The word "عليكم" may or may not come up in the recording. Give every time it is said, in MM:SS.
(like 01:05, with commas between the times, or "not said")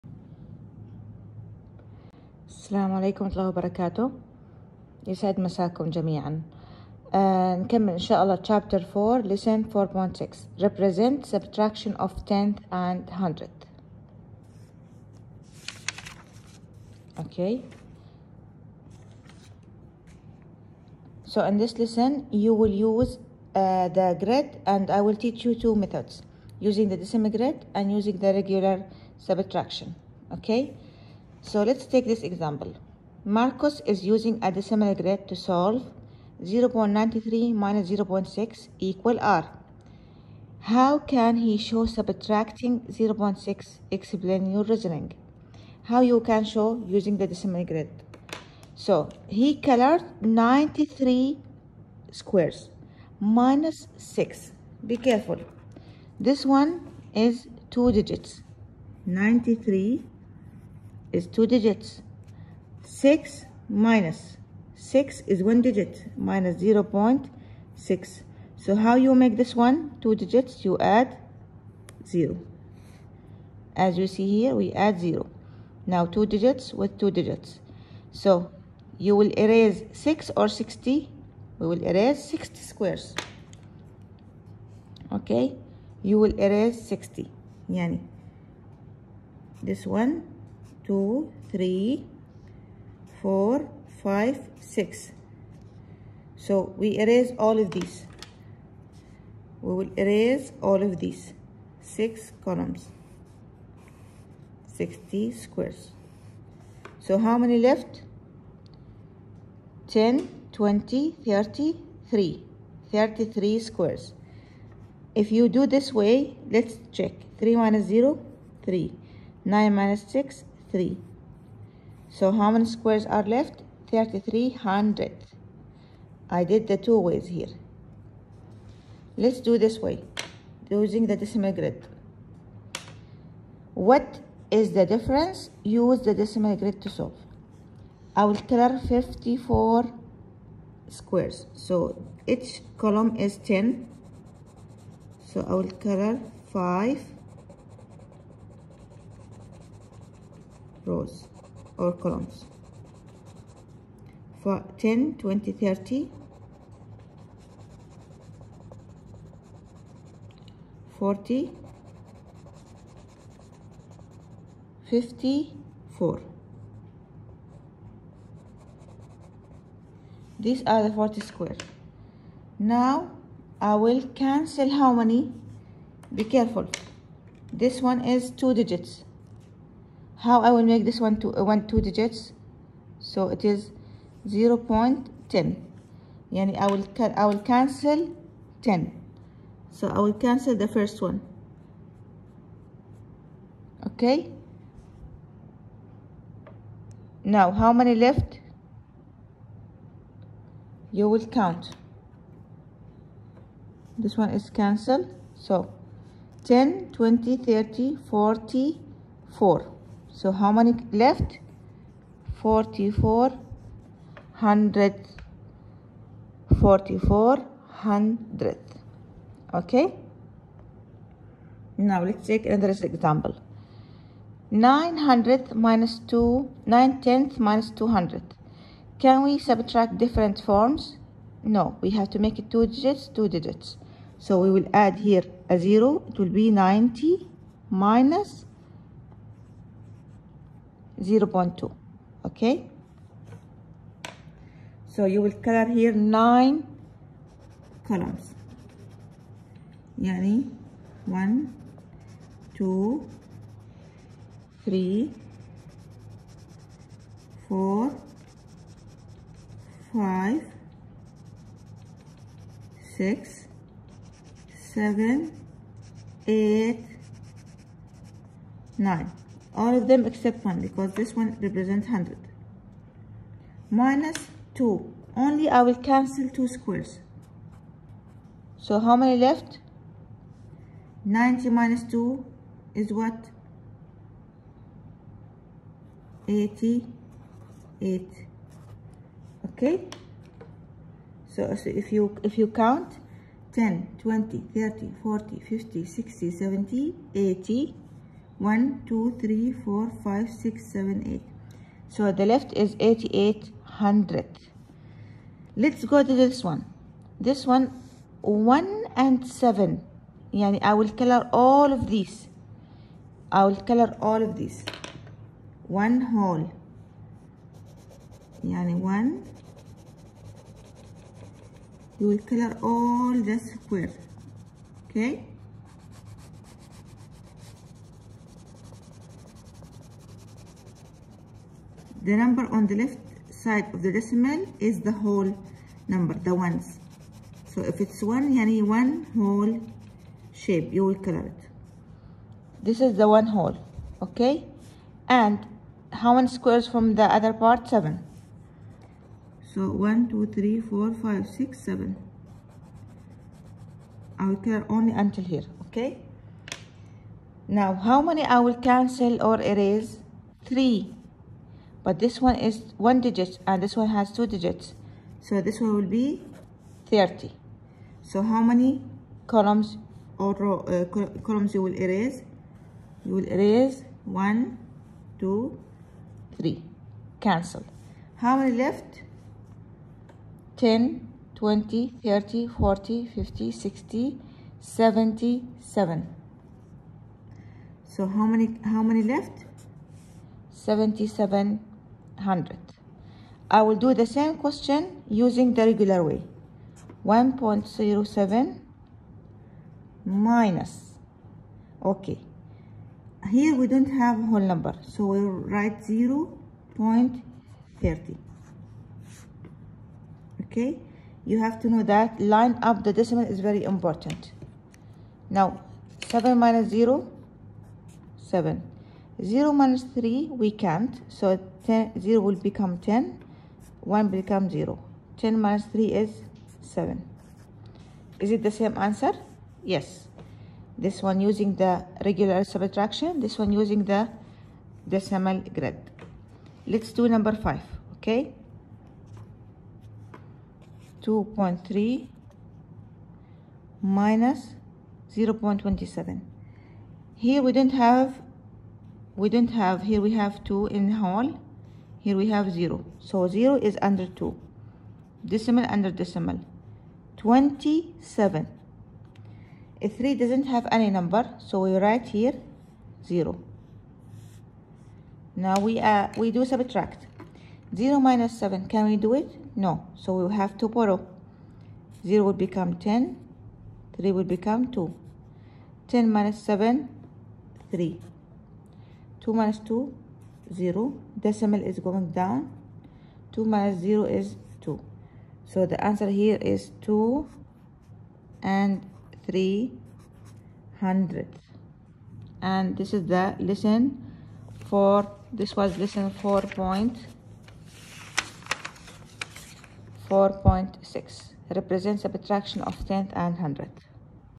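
00:02.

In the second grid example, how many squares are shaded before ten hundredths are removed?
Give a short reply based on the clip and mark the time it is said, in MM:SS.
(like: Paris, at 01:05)
54, at 02:18.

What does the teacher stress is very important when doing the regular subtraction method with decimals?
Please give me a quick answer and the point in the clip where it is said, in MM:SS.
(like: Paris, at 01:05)
Line up the decimal, at 06:52.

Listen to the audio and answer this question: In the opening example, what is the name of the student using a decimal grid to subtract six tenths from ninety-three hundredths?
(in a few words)
Marcos.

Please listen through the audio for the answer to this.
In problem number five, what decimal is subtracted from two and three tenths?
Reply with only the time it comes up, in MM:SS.
07:25.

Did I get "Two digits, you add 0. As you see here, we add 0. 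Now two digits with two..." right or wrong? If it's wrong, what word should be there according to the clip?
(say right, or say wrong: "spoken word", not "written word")
right.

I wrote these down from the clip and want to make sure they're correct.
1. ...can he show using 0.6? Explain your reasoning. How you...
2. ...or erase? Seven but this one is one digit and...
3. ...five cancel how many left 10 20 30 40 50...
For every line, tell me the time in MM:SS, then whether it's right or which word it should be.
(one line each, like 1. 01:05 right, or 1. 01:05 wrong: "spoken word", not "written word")
1. 00:40 wrong: "subtracting", not "using"
2. 05:59 wrong: "Three", not "Seven"
3. 06:16 wrong: "three", not "five".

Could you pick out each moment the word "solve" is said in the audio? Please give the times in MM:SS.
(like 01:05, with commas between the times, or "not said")
00:35, 02:16.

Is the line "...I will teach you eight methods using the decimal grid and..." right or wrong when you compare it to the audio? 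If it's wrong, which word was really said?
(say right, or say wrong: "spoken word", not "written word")
wrong: "two", not "eight".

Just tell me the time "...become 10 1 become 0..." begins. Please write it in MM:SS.
07:02.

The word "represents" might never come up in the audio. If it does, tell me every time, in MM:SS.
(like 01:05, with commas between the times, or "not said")
00:10, 04:31, 08:21.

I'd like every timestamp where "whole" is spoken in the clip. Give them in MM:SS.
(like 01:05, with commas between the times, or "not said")
05:16, 05:34, 05:39, 05:43, 06:44, 07:30.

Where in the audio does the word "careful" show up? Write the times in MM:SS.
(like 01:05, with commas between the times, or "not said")
00:54, 02:56.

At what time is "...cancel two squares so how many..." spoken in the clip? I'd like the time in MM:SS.
04:35.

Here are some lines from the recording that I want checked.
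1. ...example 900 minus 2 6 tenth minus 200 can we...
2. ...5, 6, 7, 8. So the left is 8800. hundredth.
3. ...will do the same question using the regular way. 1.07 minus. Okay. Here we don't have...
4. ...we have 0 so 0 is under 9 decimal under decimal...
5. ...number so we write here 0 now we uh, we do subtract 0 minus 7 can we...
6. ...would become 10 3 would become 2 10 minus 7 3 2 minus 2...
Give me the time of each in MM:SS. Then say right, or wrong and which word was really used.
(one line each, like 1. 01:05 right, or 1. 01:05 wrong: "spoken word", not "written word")
1. 03:42 wrong: "9", not "6"
2. 05:00 right
3. 06:33 right
4. 07:32 wrong: "2", not "9"
5. 07:40 right
6. 07:52 right.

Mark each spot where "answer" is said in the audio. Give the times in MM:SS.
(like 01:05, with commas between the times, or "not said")
07:08, 08:05.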